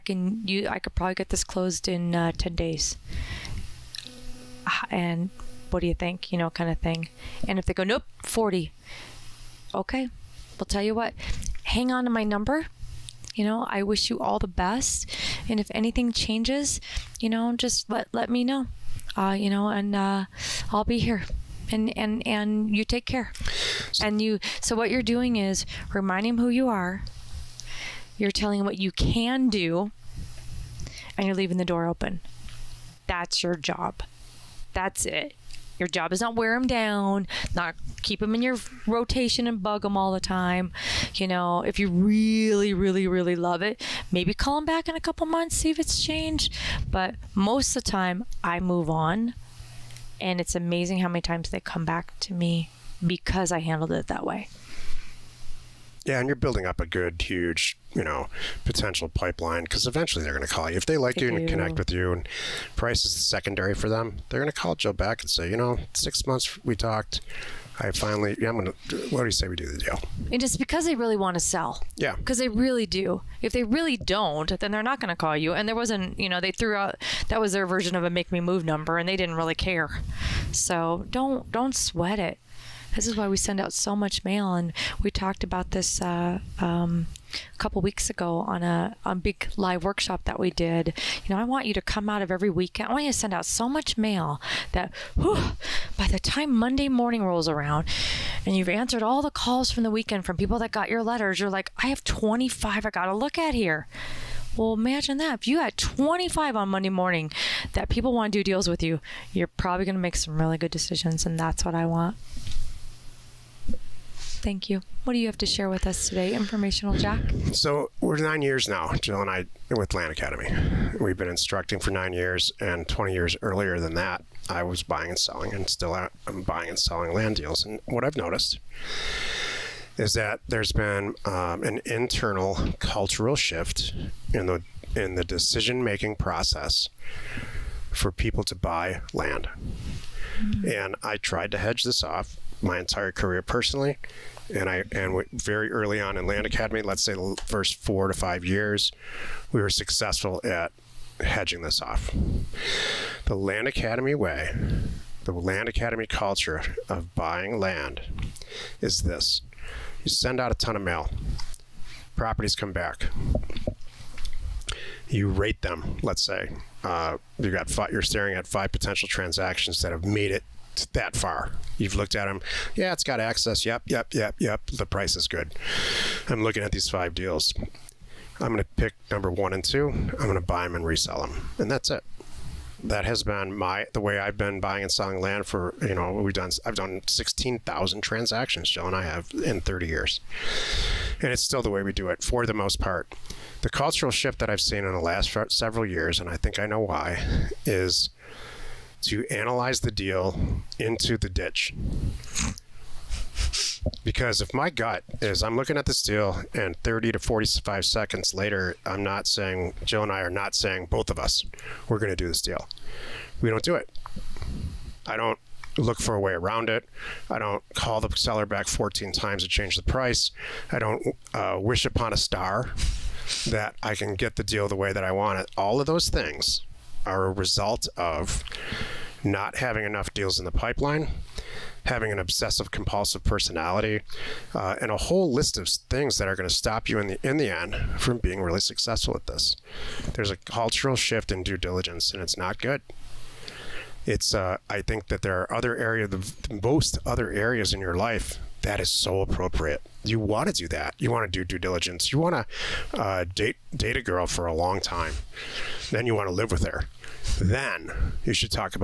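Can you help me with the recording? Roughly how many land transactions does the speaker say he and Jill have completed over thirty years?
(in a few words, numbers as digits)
16,000.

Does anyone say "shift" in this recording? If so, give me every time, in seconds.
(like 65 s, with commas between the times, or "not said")
133 s, 194 s, 240 s.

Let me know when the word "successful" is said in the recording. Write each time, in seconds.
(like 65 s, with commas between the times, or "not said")
149 s, 238 s.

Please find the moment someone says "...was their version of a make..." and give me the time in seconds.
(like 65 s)
77 s.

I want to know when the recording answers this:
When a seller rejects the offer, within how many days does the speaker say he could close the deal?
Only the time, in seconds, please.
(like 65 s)
2 s.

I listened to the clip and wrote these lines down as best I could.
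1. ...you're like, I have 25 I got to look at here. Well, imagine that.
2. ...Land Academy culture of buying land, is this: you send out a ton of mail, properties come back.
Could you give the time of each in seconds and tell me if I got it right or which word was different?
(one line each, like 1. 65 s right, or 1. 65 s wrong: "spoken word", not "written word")
1. 101 s right
2. 155 s right.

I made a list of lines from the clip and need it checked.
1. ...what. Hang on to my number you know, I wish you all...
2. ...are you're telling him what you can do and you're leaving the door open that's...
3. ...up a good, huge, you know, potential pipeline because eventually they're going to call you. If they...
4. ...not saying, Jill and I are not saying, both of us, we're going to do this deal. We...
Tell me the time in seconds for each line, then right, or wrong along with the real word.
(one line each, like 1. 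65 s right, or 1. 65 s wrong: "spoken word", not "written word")
1. 10 s right
2. 26 s right
3. 56 s right
4. 209 s right.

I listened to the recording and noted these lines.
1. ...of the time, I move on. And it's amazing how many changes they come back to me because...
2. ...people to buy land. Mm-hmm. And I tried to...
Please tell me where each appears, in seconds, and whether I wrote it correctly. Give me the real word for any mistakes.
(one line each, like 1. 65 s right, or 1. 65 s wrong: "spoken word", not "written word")
1. 47 s wrong: "times", not "changes"
2. 138 s right.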